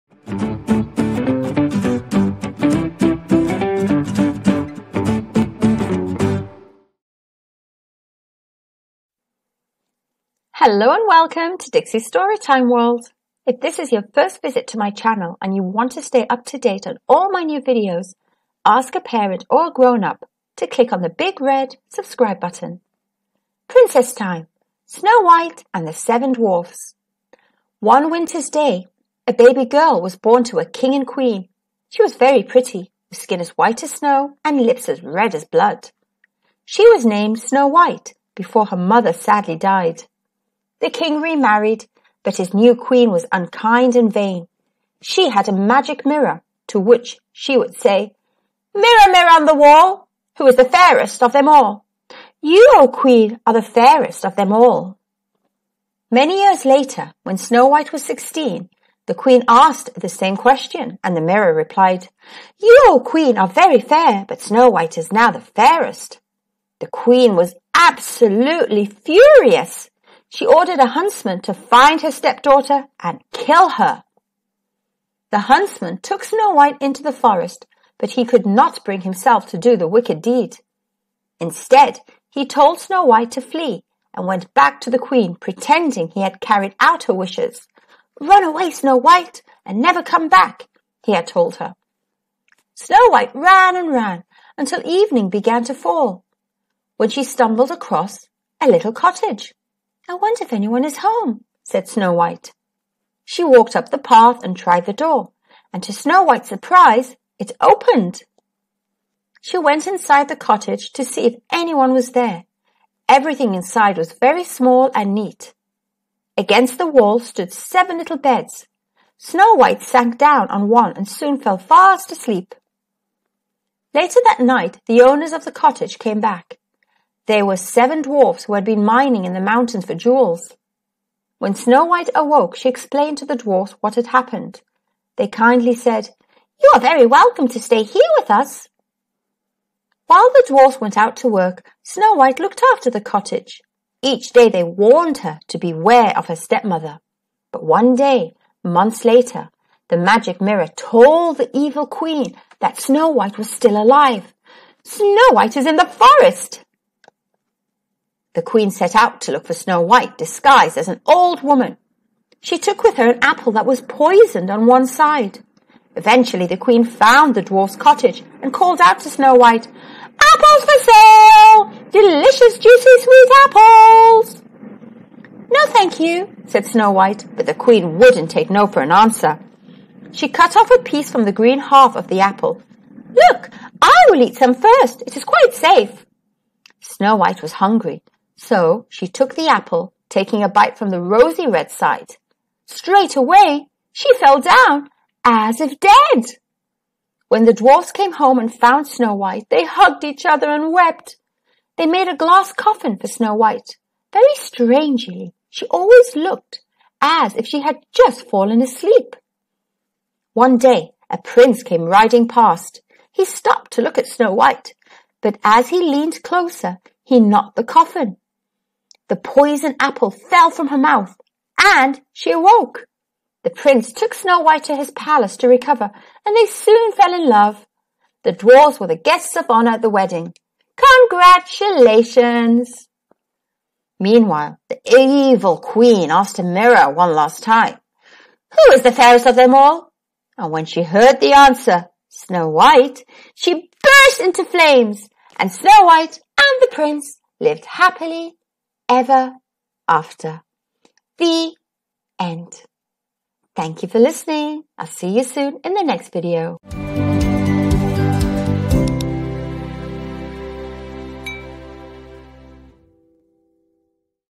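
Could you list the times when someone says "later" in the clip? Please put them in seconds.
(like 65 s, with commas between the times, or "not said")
56 s, 123 s, 149 s.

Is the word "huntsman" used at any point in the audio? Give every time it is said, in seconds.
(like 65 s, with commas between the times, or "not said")
70 s, 75 s.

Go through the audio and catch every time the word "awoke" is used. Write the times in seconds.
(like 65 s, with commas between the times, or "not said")
132 s, 222 s.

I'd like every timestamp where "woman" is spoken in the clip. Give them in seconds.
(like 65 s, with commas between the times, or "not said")
161 s.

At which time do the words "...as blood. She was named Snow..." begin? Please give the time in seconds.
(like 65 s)
35 s.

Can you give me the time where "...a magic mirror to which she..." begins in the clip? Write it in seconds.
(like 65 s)
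45 s.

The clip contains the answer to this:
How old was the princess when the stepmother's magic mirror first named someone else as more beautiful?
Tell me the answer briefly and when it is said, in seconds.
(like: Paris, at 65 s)
16, at 58 s.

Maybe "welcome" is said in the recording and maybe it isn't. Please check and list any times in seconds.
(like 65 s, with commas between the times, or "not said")
11 s, 137 s.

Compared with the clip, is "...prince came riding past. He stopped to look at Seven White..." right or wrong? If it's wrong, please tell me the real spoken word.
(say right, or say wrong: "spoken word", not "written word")
wrong: "Snow", not "Seven".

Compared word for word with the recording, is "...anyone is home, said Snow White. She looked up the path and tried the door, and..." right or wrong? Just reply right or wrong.
wrong.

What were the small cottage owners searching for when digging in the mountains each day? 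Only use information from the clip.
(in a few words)
Jewels.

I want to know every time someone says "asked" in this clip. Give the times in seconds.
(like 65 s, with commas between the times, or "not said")
59 s, 236 s.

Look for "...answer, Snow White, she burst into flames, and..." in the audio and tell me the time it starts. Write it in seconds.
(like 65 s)
241 s.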